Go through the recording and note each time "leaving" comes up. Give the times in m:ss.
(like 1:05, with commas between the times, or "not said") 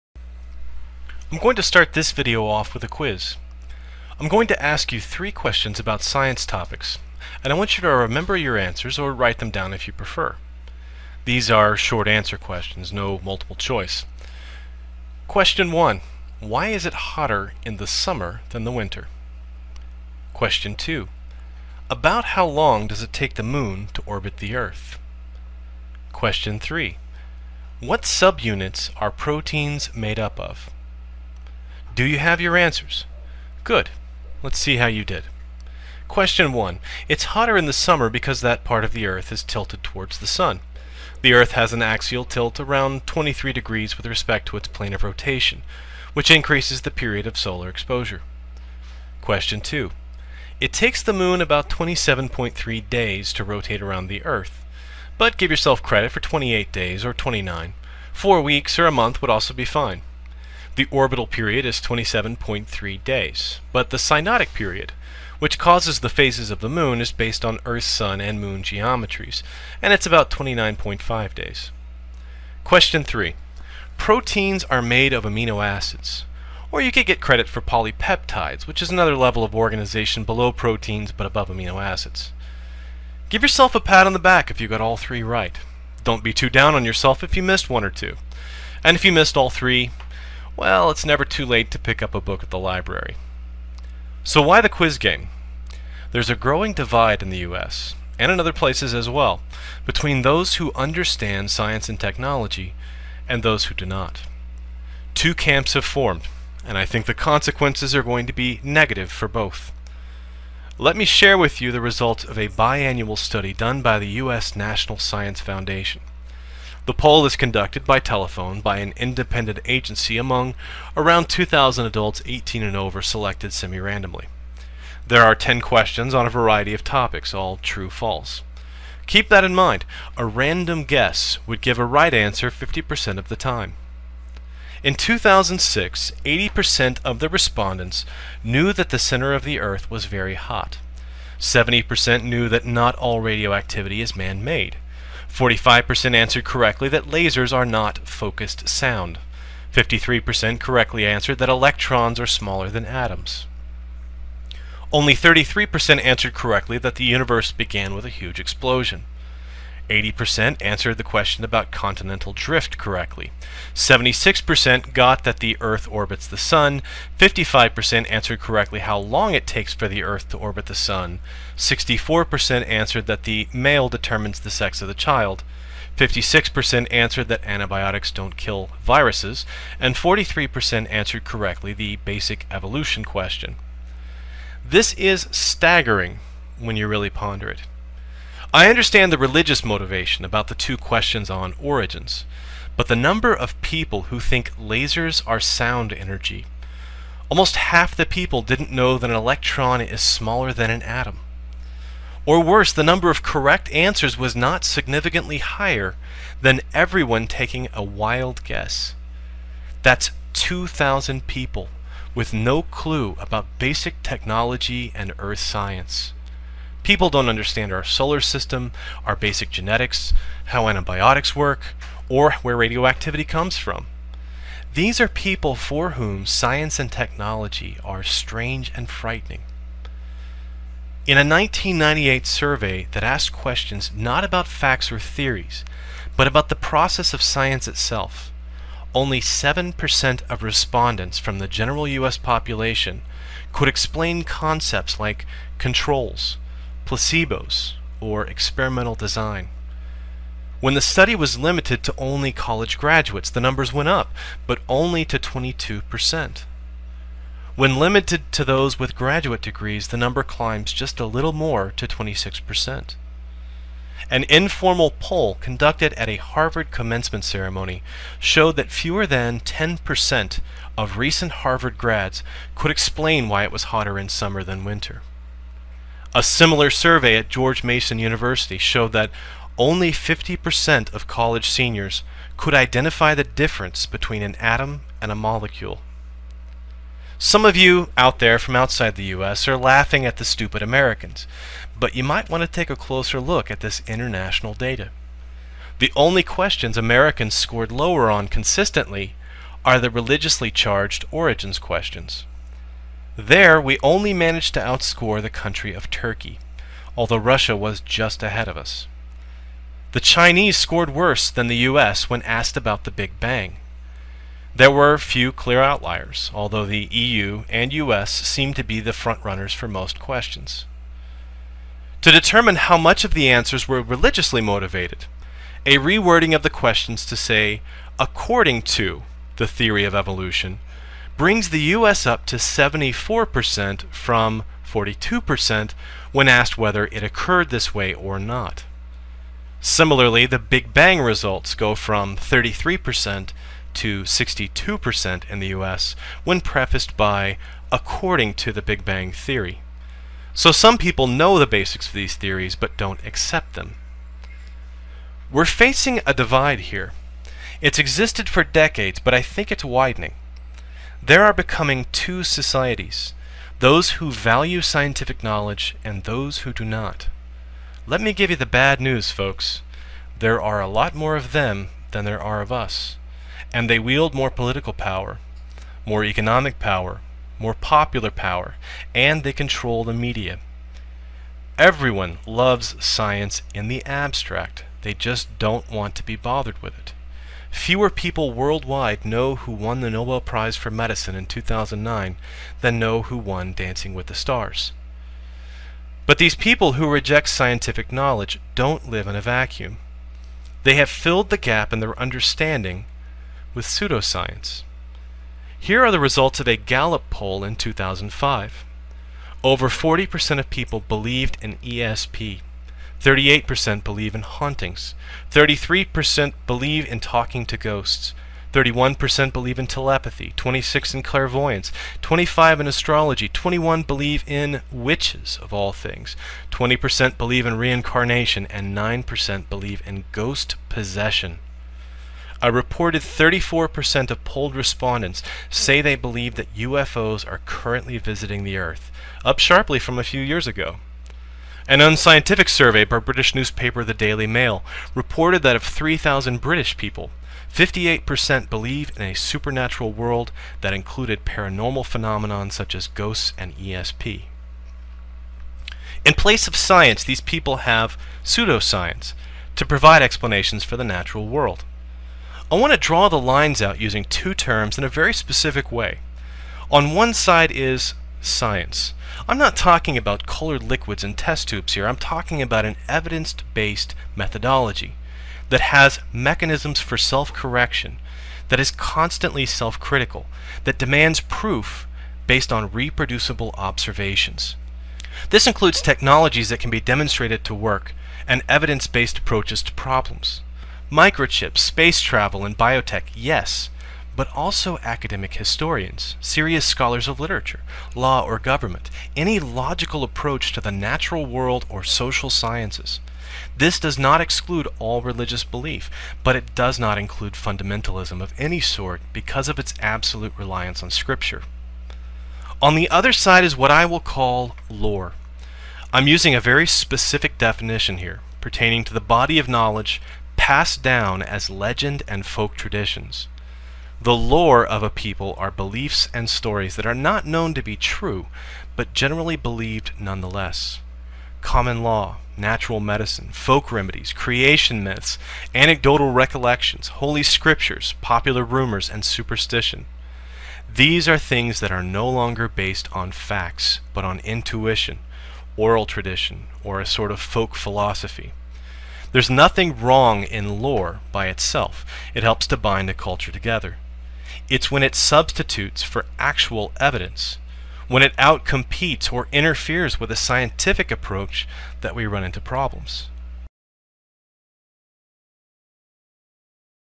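not said.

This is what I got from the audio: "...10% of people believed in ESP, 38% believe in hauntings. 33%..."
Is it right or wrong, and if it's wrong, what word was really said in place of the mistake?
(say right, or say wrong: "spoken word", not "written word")
wrong: "40", not "10".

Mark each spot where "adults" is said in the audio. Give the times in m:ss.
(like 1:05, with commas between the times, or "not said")
2:01.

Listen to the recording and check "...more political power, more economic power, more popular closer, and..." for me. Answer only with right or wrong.
wrong.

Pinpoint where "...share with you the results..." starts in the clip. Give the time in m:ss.
1:51.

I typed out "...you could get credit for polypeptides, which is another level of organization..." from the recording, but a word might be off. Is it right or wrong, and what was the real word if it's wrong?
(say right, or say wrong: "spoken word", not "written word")
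right.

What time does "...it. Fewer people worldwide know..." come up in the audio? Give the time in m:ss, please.
6:26.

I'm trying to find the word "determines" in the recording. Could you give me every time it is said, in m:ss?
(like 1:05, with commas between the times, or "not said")
2:53, 5:22.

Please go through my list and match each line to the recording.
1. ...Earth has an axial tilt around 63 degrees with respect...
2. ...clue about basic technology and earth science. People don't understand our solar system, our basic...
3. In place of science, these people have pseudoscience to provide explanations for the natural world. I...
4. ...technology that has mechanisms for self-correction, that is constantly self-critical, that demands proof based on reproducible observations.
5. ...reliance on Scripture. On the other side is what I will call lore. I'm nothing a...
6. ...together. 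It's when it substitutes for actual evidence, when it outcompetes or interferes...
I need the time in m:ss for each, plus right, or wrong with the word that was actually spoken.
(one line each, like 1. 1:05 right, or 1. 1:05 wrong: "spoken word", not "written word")
1. 0:41 wrong: "23", not "63"
2. 3:32 right
3. 7:36 right
4. 7:54 wrong: "methodology", not "technology"
5. 8:30 wrong: "using", not "nothing"
6. 9:13 right.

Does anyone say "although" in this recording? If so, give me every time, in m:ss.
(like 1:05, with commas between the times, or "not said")
5:06, 5:16.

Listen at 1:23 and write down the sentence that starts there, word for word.
Give yourself a pat on the back if you got all three right.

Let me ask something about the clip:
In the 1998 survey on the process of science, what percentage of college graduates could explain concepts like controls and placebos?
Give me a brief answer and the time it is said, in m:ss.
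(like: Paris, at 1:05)
22%, at 4:15.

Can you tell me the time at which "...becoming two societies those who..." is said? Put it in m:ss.
6:01.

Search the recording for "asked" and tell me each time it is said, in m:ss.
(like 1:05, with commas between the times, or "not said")
3:53, 5:12, 5:36.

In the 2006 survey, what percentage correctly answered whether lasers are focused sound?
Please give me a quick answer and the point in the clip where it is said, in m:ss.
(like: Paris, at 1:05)
45%, at 2:25.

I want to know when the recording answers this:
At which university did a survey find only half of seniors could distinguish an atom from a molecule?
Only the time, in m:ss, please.
4:37.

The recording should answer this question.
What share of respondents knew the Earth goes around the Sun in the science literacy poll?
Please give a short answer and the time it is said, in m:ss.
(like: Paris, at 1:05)
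76%, at 2:43.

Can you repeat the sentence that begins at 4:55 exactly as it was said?
The only questions Americans scored lower on consistently are the religiously charged origins questions.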